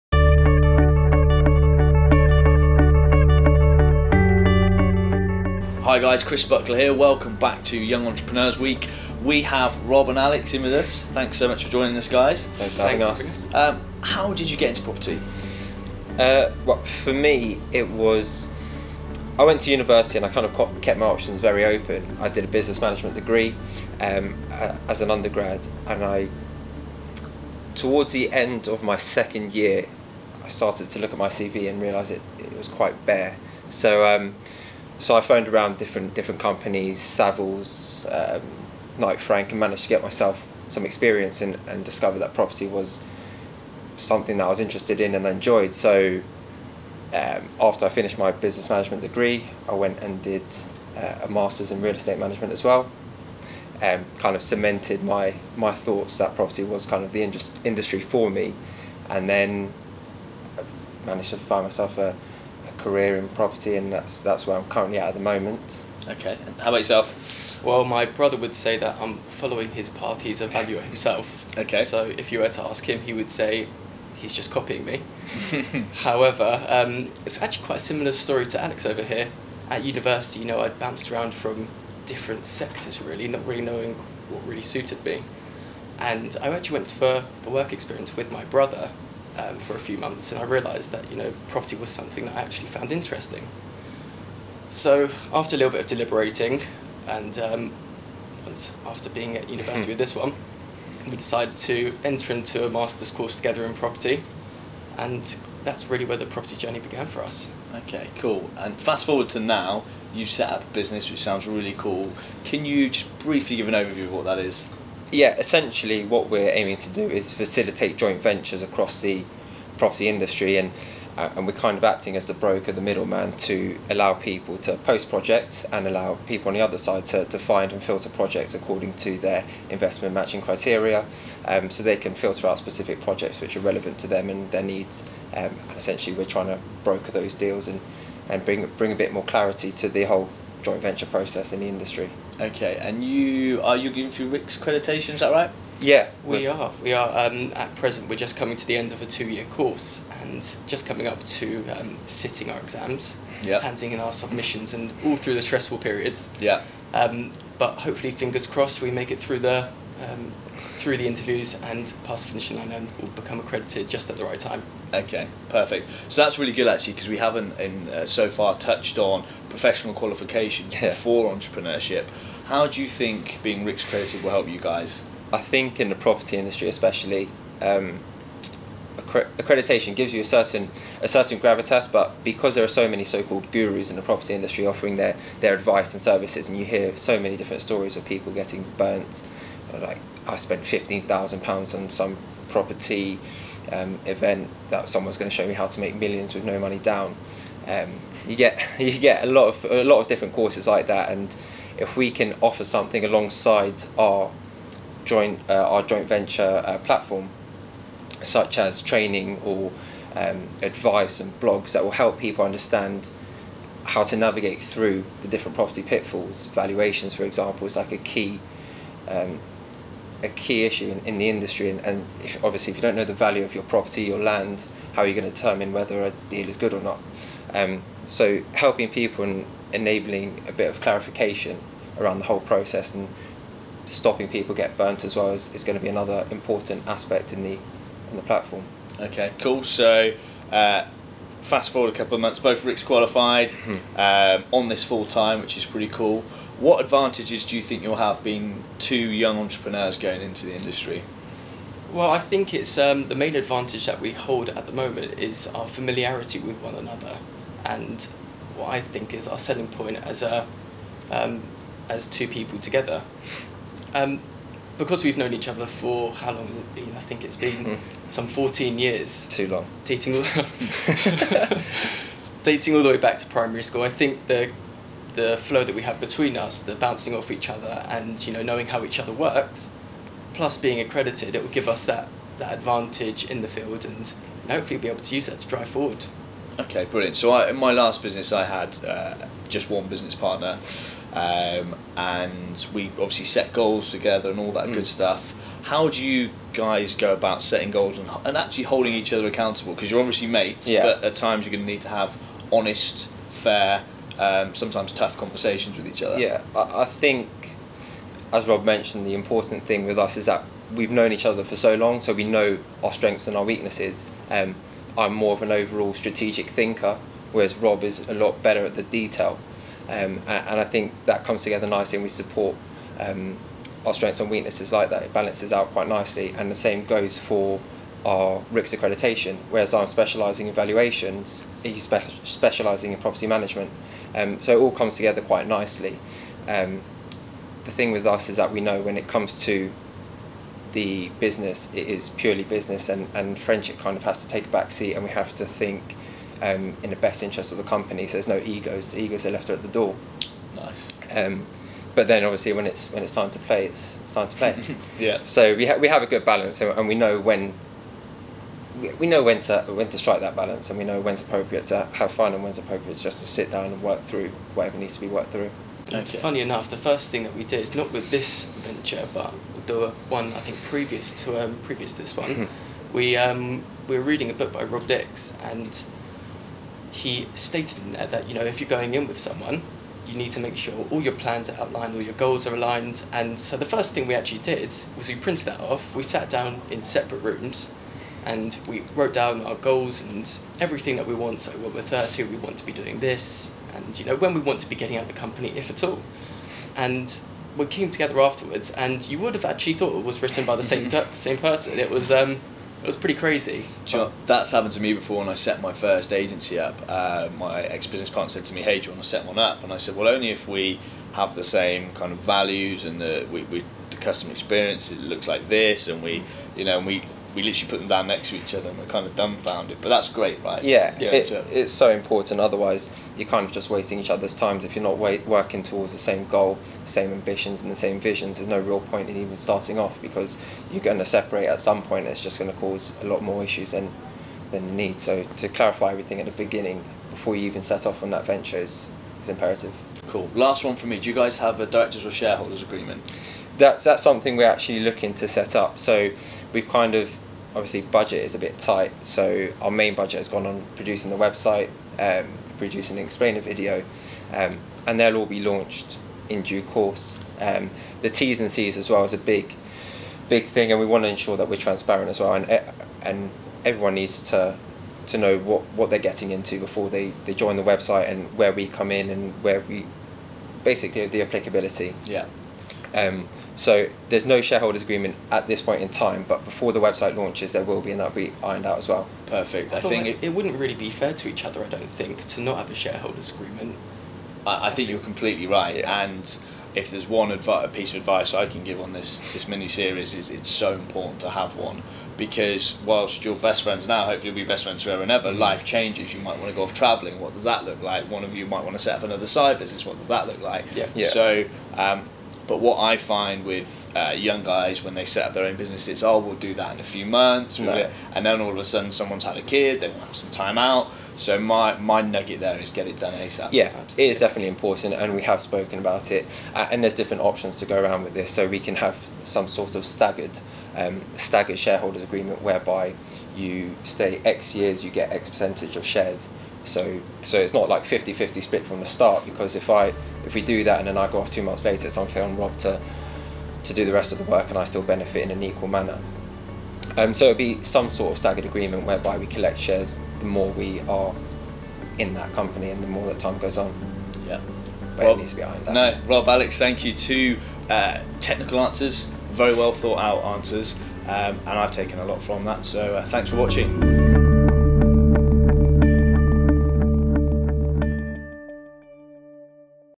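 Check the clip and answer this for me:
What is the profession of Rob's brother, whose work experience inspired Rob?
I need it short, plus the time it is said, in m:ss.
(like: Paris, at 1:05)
Valuer, at 1:10.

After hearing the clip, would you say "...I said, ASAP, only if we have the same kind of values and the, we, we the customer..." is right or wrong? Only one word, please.
wrong.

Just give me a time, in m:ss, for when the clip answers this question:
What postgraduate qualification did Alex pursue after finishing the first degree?
0:51.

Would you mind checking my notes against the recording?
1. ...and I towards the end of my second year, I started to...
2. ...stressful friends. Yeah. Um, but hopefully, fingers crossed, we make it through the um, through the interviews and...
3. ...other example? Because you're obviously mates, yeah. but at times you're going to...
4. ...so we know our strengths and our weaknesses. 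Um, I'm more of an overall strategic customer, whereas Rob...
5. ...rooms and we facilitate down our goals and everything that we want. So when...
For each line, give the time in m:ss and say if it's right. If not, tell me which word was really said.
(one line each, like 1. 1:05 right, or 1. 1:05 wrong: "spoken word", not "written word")
1. 0:25 right
2. 2:35 wrong: "periods", not "friends"
3. 4:59 wrong: "accountable", not "example"
4. 5:12 wrong: "thinker", not "customer"
5. 6:27 wrong: "wrote", not "facilitate".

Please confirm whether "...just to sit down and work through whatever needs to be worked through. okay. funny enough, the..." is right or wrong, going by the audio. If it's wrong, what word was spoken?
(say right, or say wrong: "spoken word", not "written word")
right.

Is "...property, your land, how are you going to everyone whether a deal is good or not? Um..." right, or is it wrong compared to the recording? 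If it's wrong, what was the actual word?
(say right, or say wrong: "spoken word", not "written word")
wrong: "determine", not "everyone".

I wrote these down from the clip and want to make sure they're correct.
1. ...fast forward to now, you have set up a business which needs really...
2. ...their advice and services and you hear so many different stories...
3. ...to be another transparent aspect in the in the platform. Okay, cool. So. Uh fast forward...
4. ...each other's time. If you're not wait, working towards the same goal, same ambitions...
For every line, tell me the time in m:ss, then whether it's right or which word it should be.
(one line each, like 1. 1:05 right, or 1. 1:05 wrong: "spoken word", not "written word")
1. 1:48 wrong: "sounds", not "needs"
2. 3:05 right
3. 3:55 wrong: "important", not "transparent"
4. 7:03 right.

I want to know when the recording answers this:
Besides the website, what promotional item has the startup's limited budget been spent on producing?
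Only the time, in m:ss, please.
7:33.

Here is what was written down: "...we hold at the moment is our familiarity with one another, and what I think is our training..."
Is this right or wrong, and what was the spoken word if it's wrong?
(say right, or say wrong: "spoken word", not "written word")
wrong: "selling", not "training".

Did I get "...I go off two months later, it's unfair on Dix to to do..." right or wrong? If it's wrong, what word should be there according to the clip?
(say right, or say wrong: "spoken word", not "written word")
wrong: "Rob", not "Dix".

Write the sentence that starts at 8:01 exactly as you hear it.
I don't think to not have a shareholders agreement.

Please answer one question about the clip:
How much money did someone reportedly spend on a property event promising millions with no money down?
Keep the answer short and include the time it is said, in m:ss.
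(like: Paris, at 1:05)
£15,000, at 3:10.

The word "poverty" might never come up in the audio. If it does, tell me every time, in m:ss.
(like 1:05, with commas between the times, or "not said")
not said.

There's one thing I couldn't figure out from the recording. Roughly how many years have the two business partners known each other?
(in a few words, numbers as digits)
14.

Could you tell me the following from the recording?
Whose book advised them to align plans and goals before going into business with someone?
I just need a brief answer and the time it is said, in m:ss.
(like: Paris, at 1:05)
Rob Dix, at 6:14.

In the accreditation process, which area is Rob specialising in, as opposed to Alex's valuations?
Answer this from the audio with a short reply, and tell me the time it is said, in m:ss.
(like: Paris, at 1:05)
Property management, at 5:32.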